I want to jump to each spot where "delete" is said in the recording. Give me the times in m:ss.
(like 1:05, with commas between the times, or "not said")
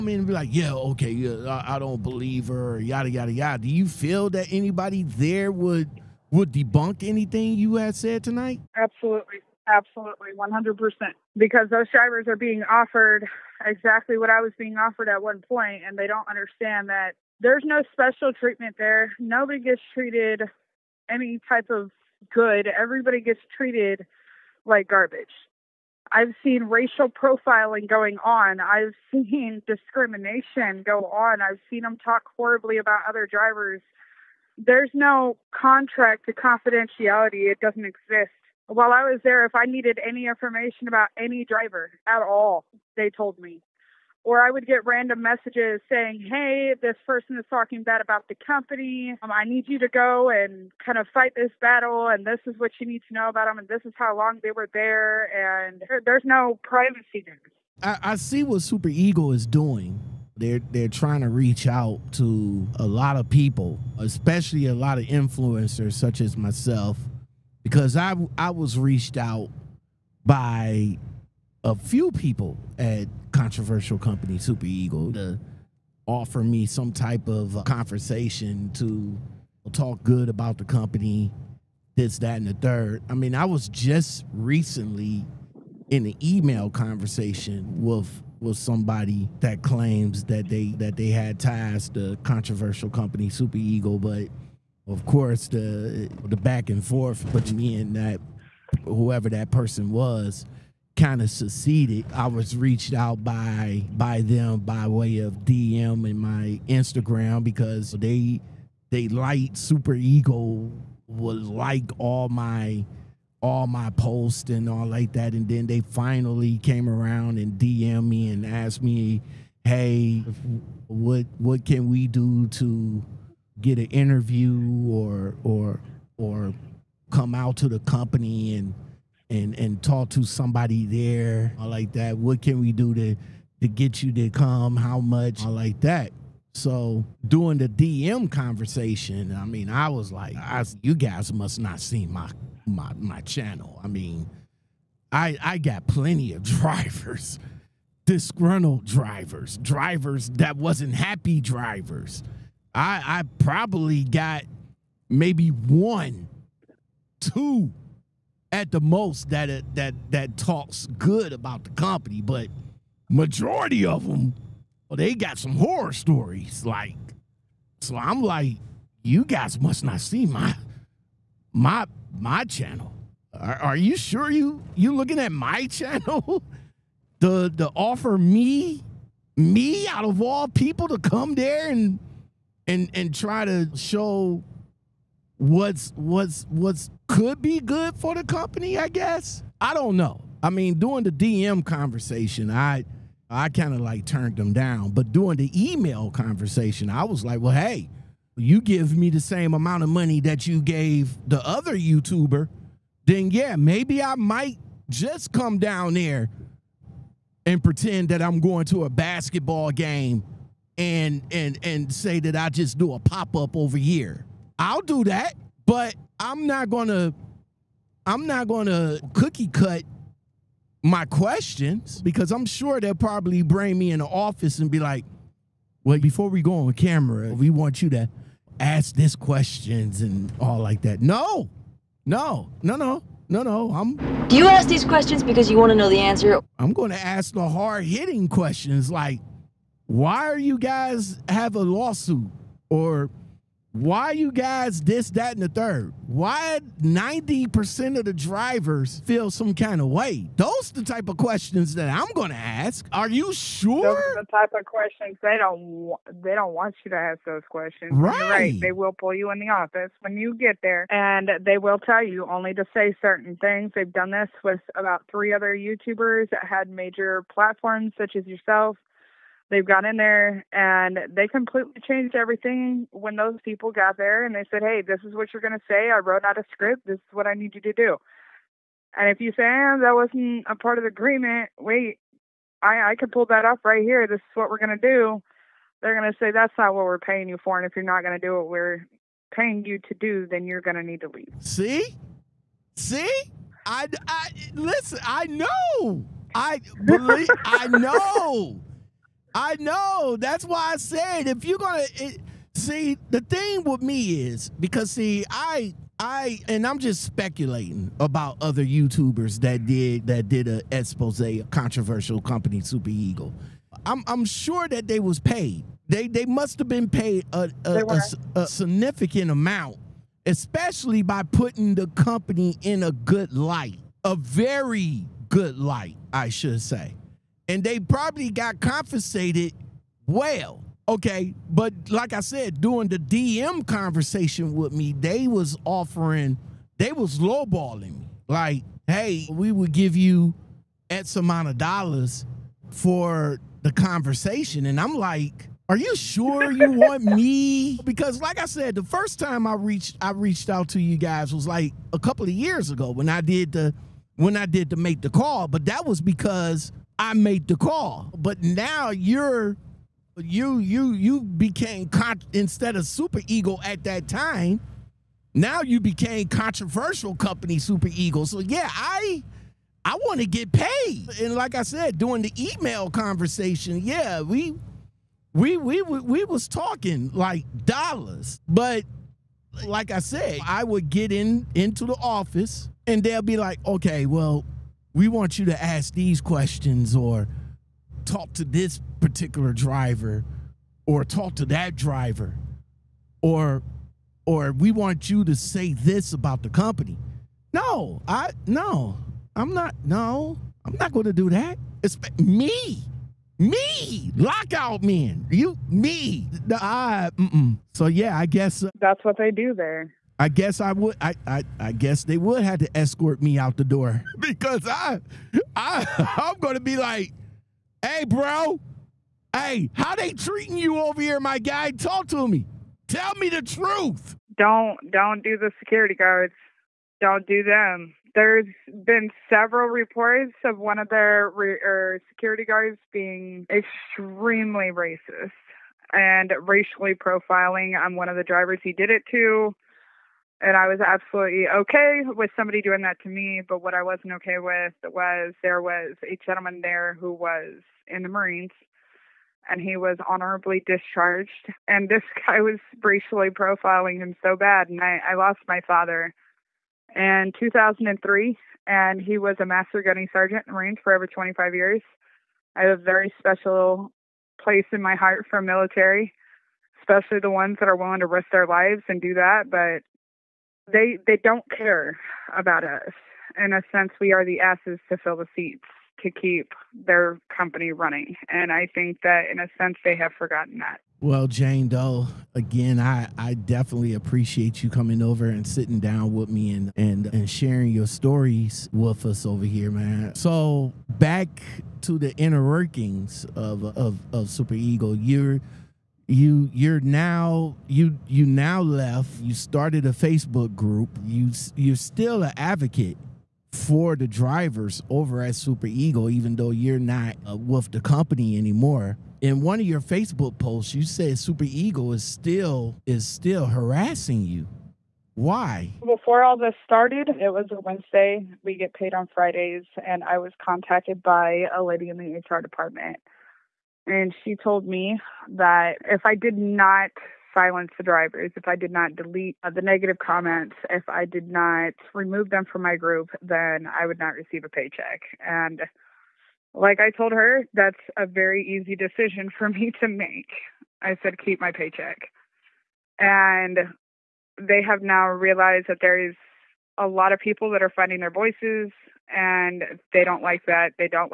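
8:48.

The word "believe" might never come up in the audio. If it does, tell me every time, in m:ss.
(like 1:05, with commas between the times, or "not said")
0:02, 4:56.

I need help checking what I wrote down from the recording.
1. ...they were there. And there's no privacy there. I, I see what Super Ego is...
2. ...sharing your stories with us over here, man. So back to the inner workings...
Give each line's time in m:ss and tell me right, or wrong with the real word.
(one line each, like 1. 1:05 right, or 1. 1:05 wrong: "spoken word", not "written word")
1. 0:54 right
2. 8:07 right.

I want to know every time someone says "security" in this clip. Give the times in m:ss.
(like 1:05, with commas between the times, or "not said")
7:05, 7:12.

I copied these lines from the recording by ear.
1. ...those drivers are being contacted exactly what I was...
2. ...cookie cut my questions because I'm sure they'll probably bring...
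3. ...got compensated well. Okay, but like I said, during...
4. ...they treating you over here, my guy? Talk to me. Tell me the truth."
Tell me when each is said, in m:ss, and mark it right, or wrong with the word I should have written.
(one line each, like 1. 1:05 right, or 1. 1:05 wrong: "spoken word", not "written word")
1. 0:11 wrong: "offered", not "contacted"
2. 3:39 right
3. 5:28 right
4. 6:59 right.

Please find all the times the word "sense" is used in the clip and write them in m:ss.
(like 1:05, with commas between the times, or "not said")
7:53, 7:59.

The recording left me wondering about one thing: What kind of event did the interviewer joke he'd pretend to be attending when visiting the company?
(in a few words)
basketball game.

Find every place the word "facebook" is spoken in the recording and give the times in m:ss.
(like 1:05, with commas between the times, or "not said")
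8:19, 8:29.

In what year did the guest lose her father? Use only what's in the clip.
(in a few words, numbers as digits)
2003.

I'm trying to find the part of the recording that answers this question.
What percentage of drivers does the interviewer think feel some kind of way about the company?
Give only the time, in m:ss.
4:06.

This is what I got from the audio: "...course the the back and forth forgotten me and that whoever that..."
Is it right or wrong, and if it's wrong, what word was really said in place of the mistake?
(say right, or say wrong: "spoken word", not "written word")
wrong: "between", not "forgotten".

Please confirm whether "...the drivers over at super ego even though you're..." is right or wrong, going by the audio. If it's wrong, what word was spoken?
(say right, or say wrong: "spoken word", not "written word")
right.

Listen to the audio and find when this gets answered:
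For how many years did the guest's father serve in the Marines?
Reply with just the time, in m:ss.
7:40.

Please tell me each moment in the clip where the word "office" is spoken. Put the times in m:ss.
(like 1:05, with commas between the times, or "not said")
3:44, 4:19, 6:21.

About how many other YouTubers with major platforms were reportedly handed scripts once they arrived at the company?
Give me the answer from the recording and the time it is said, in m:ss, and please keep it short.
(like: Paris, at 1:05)
3, at 4:25.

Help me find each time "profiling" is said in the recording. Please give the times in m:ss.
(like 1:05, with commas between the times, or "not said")
0:27, 7:16, 7:33.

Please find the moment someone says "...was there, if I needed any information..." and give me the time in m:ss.
0:39.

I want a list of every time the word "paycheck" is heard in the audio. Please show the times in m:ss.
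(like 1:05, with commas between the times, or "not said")
8:54, 9:01.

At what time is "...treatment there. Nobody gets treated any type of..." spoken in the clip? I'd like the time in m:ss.
0:18.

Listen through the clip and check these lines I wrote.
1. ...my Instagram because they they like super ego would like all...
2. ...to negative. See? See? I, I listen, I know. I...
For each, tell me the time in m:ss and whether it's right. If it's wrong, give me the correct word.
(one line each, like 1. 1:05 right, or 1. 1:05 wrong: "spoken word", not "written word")
1. 1:46 right
2. 4:51 wrong: "leave", not "negative".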